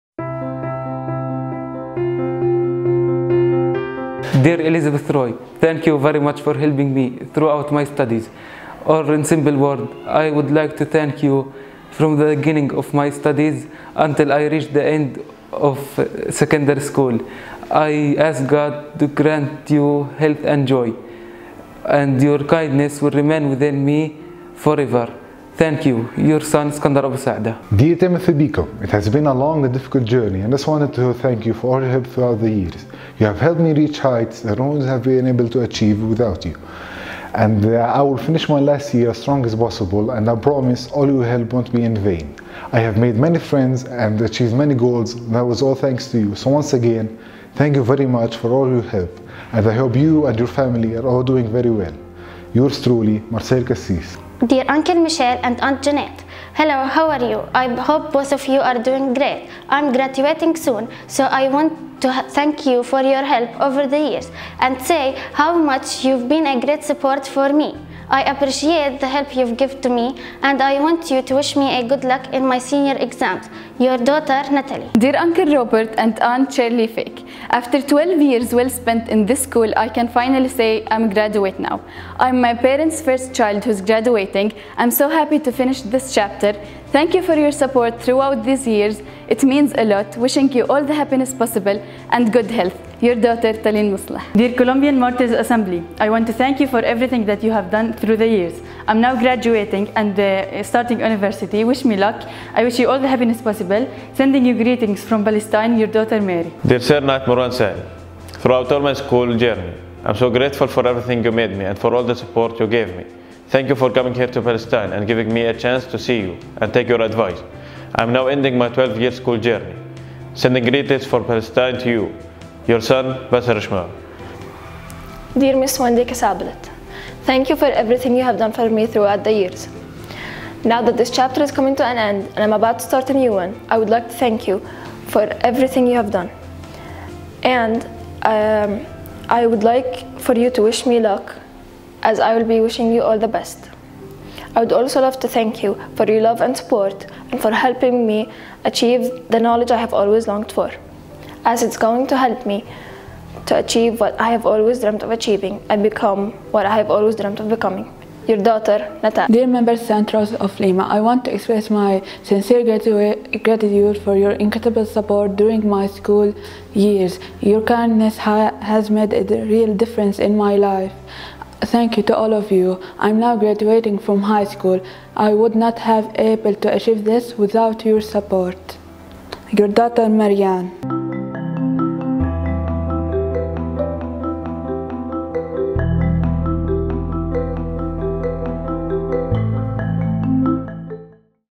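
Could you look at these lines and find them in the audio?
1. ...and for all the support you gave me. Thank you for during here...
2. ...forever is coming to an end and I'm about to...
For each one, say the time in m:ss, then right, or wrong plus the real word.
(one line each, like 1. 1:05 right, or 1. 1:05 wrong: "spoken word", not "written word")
1. 1:51 wrong: "coming", not "during"
2. 2:11 wrong: "chapter", not "forever".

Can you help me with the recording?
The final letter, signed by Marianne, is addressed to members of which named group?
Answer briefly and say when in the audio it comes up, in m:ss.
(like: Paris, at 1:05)
Saint Rose of Lima, at 2:39.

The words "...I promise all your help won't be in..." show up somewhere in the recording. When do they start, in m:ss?
0:40.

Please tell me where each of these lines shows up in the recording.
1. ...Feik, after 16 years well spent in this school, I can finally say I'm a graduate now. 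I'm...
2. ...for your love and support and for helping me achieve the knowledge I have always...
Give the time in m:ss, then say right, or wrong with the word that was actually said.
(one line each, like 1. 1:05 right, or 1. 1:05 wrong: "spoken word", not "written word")
1. 1:16 wrong: "12", not "16"
2. 2:25 right.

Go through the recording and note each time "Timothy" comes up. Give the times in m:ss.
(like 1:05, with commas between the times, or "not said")
0:27.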